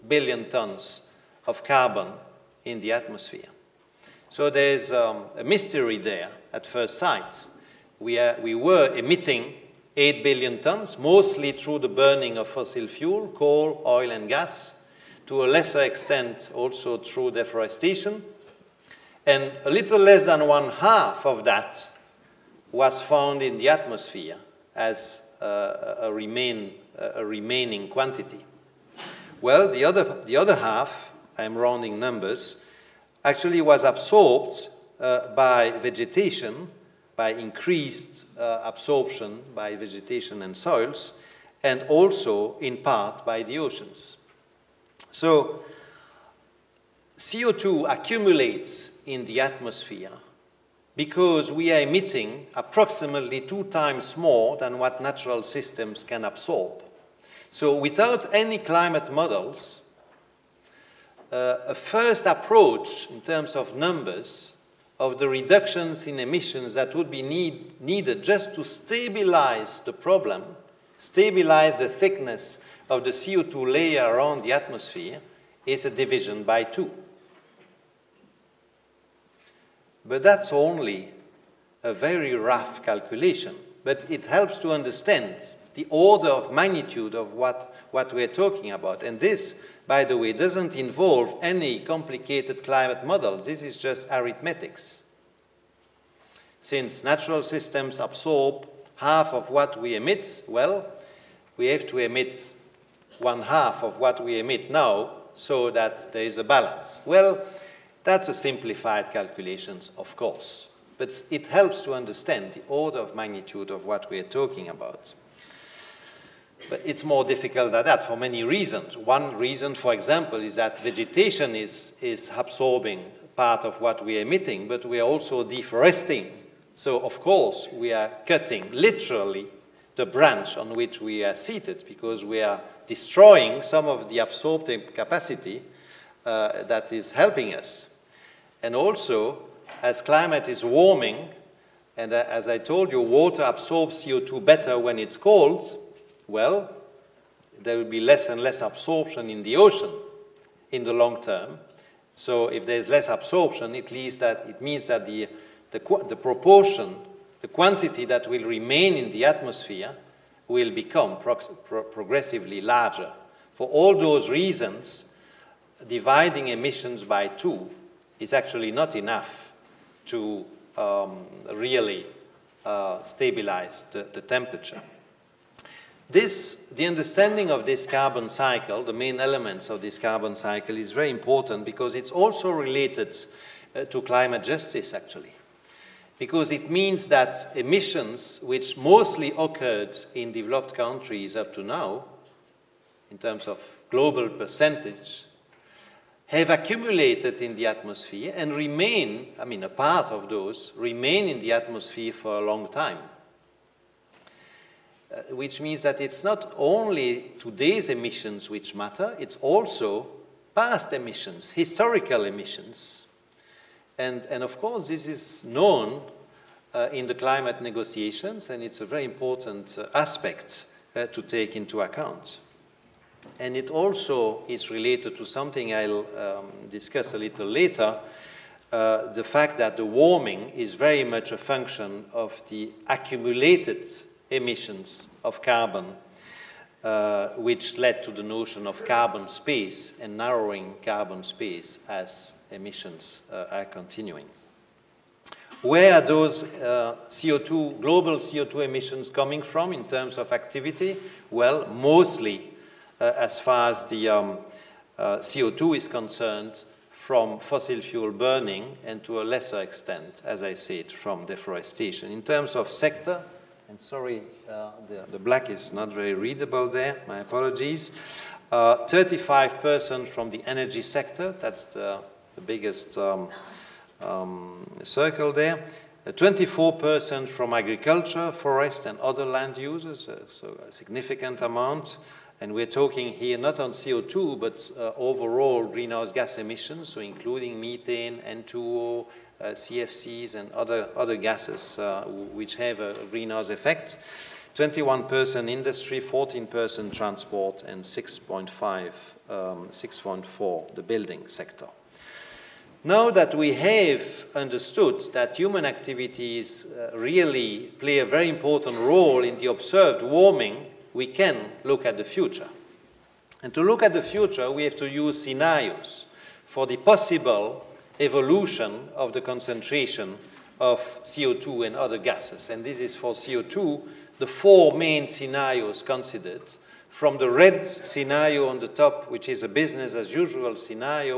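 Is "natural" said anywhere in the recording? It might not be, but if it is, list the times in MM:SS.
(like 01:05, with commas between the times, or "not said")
00:55, 01:37.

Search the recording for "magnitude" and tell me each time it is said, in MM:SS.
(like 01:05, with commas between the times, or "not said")
01:26, 01:53.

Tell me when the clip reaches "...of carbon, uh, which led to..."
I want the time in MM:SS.
03:55.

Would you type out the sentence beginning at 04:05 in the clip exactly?
Where are those uh, CO2, global CO2 emissions coming from in terms of activity?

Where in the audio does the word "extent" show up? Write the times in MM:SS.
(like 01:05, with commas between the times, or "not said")
00:15, 04:19.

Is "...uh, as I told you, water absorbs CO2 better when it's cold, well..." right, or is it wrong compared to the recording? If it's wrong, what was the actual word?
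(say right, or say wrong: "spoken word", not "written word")
right.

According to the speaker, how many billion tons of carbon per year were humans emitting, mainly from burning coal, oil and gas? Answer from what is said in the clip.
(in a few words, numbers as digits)
8 billion tons.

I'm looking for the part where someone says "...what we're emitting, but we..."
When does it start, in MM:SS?
02:03.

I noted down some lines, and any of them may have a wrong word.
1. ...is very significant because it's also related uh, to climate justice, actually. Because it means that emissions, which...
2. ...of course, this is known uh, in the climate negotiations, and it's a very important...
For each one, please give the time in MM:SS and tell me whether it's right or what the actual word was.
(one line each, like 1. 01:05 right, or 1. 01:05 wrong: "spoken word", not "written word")
1. 03:00 wrong: "important", not "significant"
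2. 03:34 right.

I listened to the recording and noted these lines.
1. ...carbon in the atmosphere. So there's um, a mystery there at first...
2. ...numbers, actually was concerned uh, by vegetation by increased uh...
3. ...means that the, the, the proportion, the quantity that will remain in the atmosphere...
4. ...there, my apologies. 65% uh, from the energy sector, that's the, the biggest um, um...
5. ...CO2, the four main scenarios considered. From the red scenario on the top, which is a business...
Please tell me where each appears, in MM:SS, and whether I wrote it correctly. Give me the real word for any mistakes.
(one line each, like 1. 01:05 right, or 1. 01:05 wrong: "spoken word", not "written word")
1. 00:01 right
2. 00:31 wrong: "absorbed", not "concerned"
3. 02:34 right
4. 04:26 wrong: "35", not "65"
5. 05:23 right.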